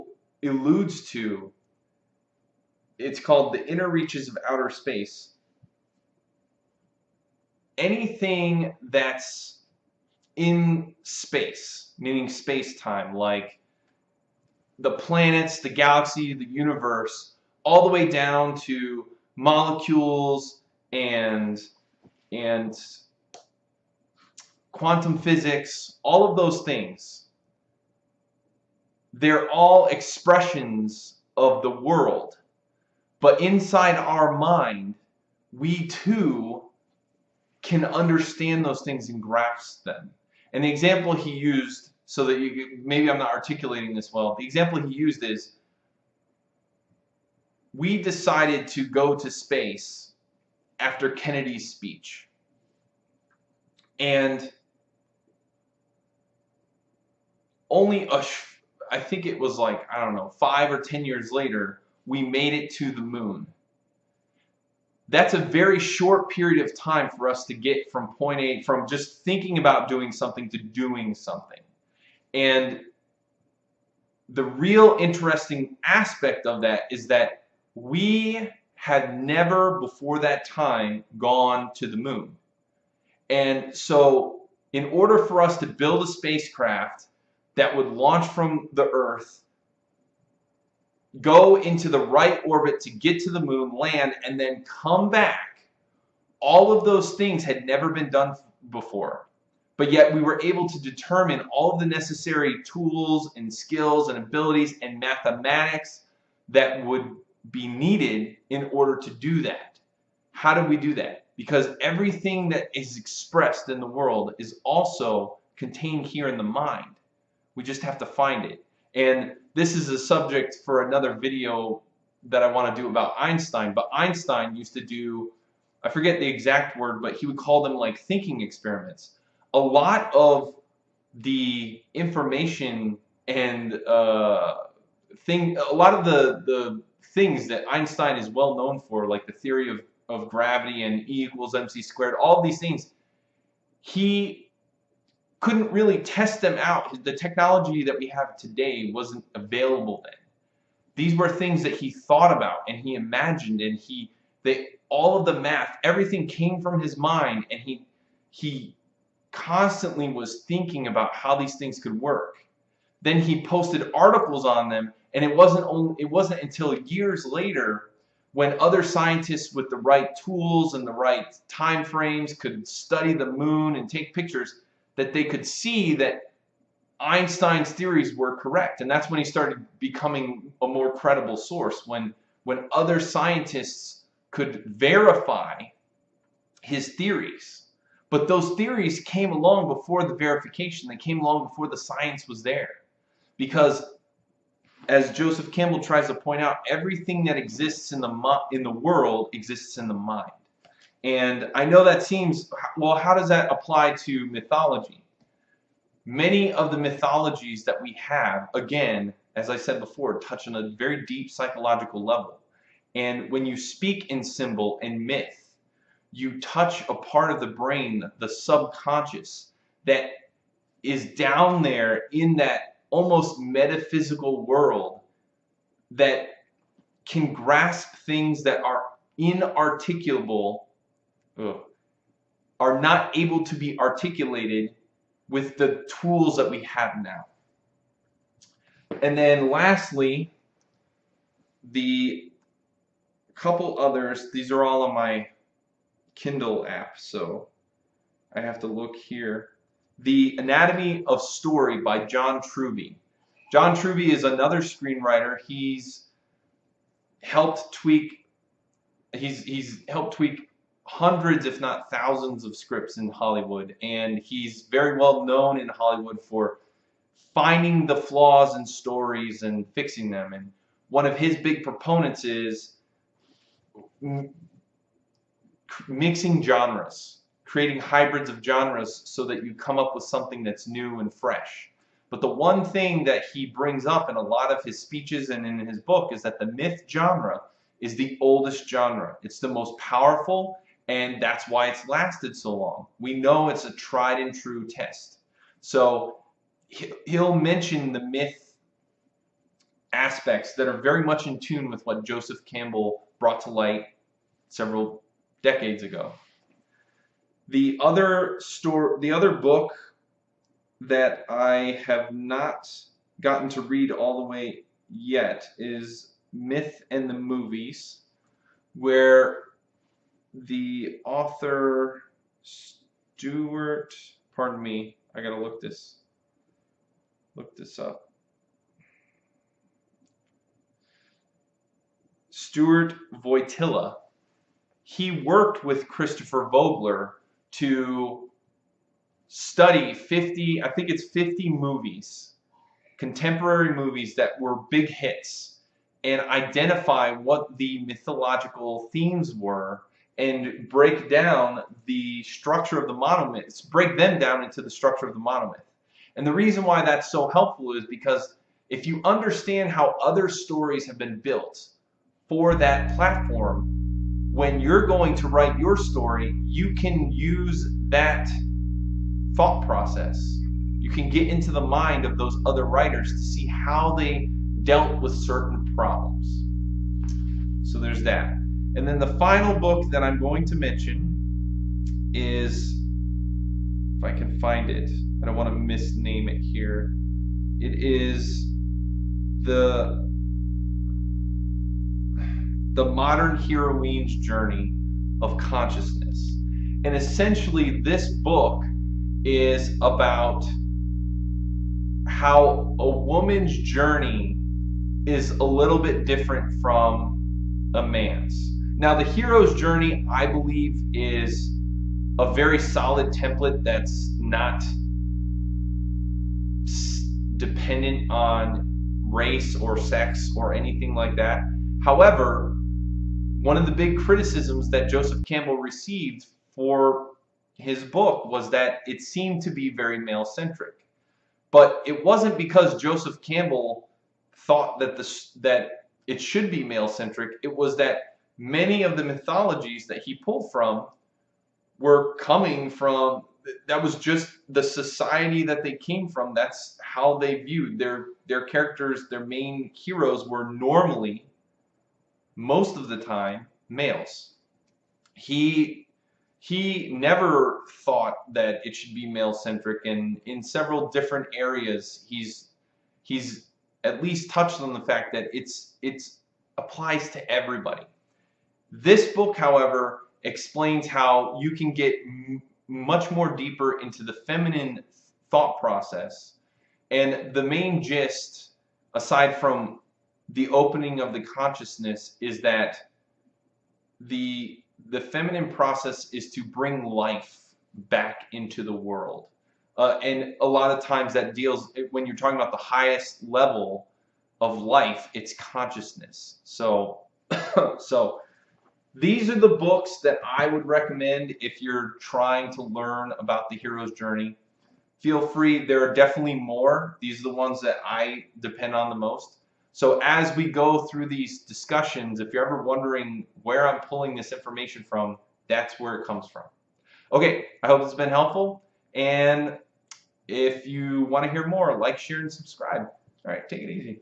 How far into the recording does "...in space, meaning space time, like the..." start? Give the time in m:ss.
0:10.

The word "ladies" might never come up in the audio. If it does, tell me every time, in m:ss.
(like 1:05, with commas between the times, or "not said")
not said.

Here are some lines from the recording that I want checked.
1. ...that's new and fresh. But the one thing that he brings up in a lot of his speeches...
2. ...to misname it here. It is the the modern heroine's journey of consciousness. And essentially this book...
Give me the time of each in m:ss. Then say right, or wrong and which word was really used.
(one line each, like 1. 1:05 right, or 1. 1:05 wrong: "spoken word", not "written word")
1. 4:40 right
2. 6:25 right.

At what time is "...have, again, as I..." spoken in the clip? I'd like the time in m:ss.
3:27.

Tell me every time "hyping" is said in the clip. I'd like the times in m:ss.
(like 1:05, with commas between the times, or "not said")
not said.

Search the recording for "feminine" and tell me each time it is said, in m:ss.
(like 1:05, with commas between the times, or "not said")
7:54, 8:05.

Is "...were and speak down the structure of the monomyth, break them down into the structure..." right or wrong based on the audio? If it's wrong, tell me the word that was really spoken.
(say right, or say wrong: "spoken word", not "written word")
wrong: "break", not "speak".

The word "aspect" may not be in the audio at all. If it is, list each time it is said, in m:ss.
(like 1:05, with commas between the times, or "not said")
1:15, 4:59.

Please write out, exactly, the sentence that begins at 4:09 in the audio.
The Anatomy of Story by John Truby.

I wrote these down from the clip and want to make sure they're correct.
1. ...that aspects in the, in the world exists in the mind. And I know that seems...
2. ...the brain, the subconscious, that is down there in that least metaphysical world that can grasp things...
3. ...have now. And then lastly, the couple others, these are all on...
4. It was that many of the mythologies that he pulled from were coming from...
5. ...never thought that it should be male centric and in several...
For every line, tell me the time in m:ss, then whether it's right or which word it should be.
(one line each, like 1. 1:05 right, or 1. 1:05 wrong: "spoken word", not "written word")
1. 3:17 wrong: "exists", not "aspects"
2. 3:37 wrong: "almost", not "least"
3. 3:56 right
4. 7:17 right
5. 7:36 right.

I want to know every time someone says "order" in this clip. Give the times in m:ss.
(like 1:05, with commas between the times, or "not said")
1:24, 1:48.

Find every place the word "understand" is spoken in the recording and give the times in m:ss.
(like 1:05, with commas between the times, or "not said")
0:37, 5:59.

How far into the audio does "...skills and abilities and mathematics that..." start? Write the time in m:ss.
1:43.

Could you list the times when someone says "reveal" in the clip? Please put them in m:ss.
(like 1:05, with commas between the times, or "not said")
not said.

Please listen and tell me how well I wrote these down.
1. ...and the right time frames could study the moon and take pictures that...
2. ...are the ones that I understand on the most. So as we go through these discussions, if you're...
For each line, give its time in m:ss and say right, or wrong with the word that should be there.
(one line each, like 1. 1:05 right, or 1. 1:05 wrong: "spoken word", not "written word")
1. 2:50 right
2. 8:27 wrong: "depend", not "understand".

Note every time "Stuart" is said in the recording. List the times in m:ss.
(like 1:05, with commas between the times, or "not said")
5:22, 5:32.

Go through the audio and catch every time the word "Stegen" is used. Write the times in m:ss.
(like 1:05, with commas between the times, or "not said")
not said.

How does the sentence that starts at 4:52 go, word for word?
We know it's a tried and true test.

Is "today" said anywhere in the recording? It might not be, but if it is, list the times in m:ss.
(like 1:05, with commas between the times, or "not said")
2:28.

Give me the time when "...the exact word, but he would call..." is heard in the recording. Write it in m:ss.
2:06.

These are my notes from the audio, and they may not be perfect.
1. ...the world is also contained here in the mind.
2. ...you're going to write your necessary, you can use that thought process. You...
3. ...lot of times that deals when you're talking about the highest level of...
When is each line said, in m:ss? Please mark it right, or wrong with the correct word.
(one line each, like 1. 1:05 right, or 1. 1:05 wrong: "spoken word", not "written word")
1. 1:53 right
2. 6:04 wrong: "story", not "necessary"
3. 8:10 right.